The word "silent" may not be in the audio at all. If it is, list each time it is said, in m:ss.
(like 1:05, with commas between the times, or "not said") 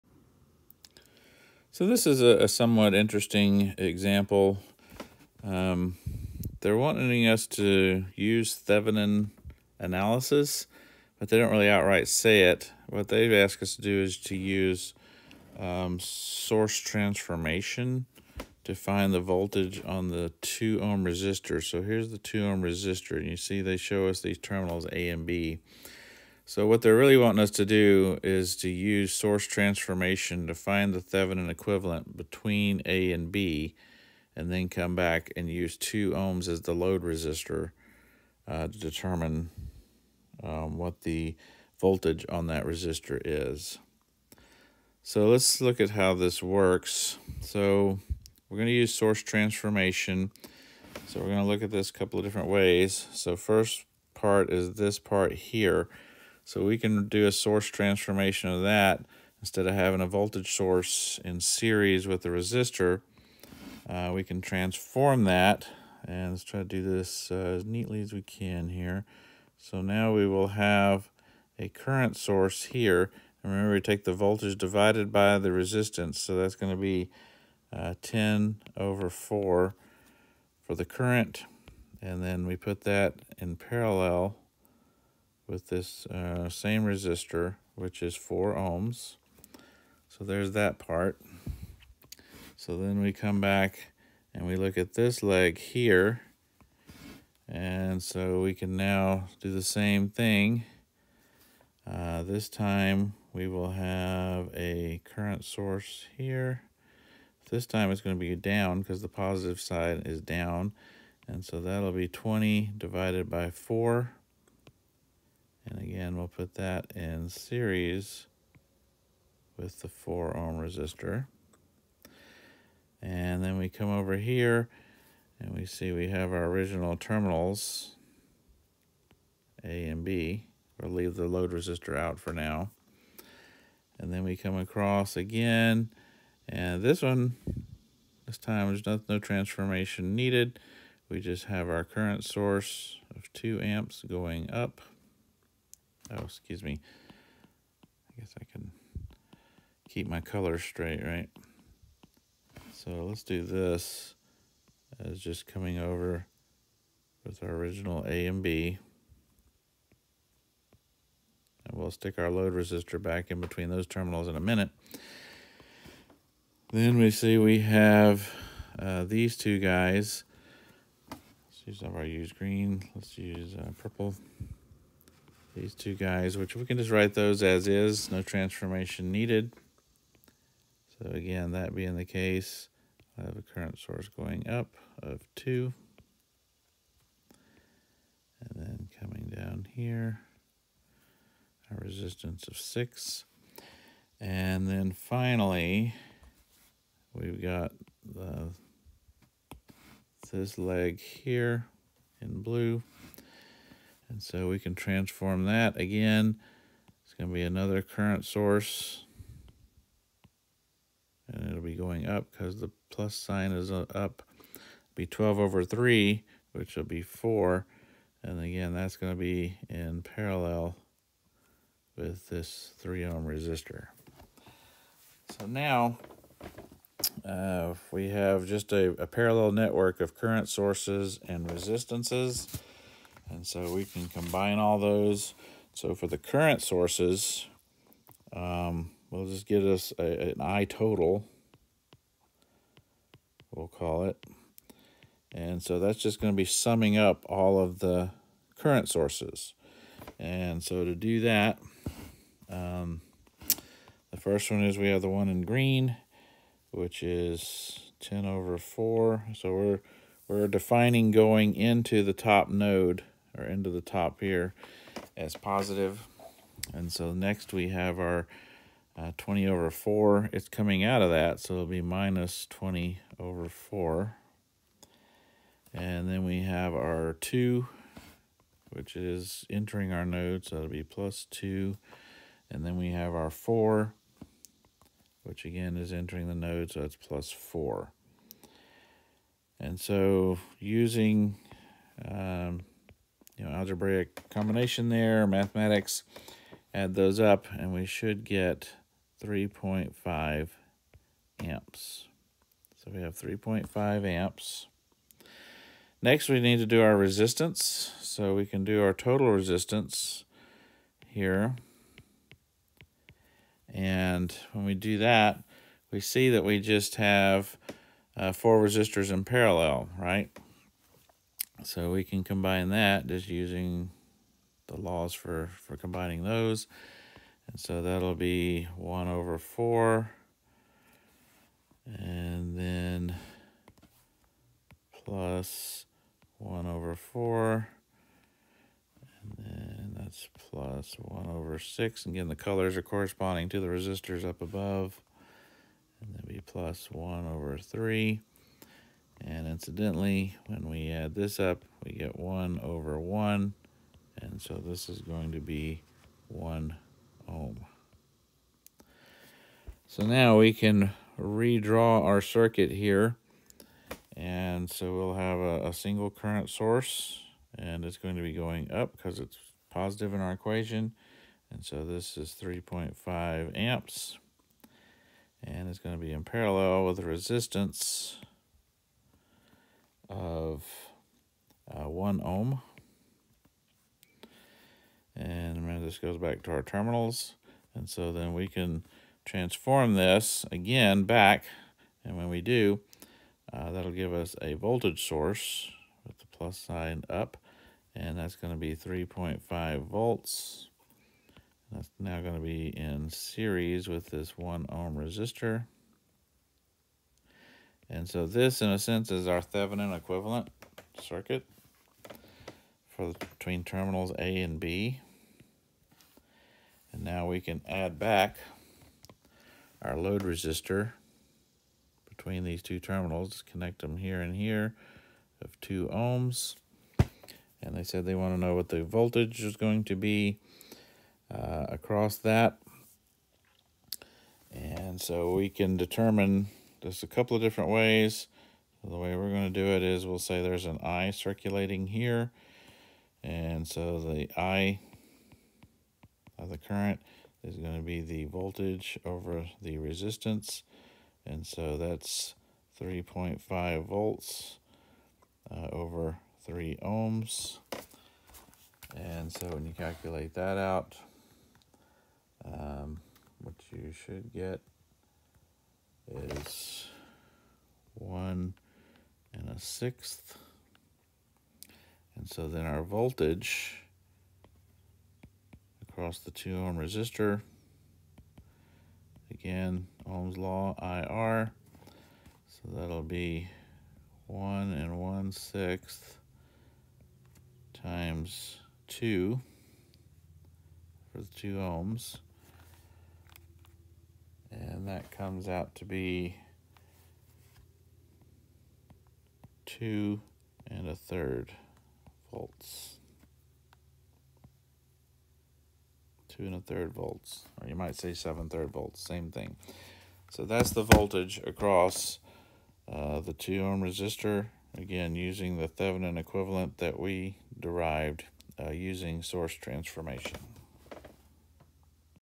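not said.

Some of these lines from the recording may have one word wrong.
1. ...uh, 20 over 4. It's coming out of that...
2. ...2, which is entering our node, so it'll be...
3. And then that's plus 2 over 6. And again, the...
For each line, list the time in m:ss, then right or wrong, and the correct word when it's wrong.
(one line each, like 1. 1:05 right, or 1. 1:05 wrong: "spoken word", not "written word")
1. 4:28 right
2. 4:37 right
3. 5:39 wrong: "1", not "2".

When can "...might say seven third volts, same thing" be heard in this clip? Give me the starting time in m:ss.
8:27.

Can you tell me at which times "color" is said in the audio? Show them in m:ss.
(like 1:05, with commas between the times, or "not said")
2:30, 5:42.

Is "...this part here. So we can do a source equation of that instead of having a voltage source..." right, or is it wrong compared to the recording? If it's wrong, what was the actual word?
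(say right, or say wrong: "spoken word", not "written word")
wrong: "transformation", not "equation".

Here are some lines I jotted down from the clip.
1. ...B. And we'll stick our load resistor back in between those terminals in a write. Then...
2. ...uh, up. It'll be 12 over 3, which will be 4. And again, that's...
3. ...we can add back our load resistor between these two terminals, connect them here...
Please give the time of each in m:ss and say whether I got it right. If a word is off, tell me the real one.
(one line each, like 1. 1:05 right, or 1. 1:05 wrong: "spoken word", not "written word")
1. 2:38 wrong: "minute", not "write"
2. 3:33 right
3. 6:57 right.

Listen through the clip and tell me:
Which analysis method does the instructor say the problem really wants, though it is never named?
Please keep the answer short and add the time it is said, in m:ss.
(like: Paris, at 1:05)
Thevenin analysis, at 0:08.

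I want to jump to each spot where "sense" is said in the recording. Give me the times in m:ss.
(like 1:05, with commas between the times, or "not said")
6:48.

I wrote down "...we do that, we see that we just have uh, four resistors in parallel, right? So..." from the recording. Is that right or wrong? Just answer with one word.
right.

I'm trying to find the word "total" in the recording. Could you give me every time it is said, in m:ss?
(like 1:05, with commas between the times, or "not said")
4:00, 5:08.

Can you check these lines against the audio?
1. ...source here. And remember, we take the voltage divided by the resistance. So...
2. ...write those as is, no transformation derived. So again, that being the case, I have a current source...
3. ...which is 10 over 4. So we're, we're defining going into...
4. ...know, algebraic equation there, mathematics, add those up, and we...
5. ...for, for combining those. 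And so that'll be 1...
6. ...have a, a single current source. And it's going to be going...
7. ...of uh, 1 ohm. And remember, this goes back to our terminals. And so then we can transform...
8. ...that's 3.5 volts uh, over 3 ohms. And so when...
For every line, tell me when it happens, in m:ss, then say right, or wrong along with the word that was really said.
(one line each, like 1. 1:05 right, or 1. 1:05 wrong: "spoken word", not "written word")
1. 1:12 right
2. 2:56 wrong: "needed", not "derived"
3. 4:16 right
4. 4:53 wrong: "combination", not "equation"
5. 5:25 right
6. 6:05 right
7. 6:20 right
8. 7:31 right.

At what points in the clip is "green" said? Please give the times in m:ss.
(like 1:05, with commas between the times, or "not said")
2:52, 4:15.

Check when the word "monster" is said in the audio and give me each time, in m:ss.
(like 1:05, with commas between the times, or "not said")
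not said.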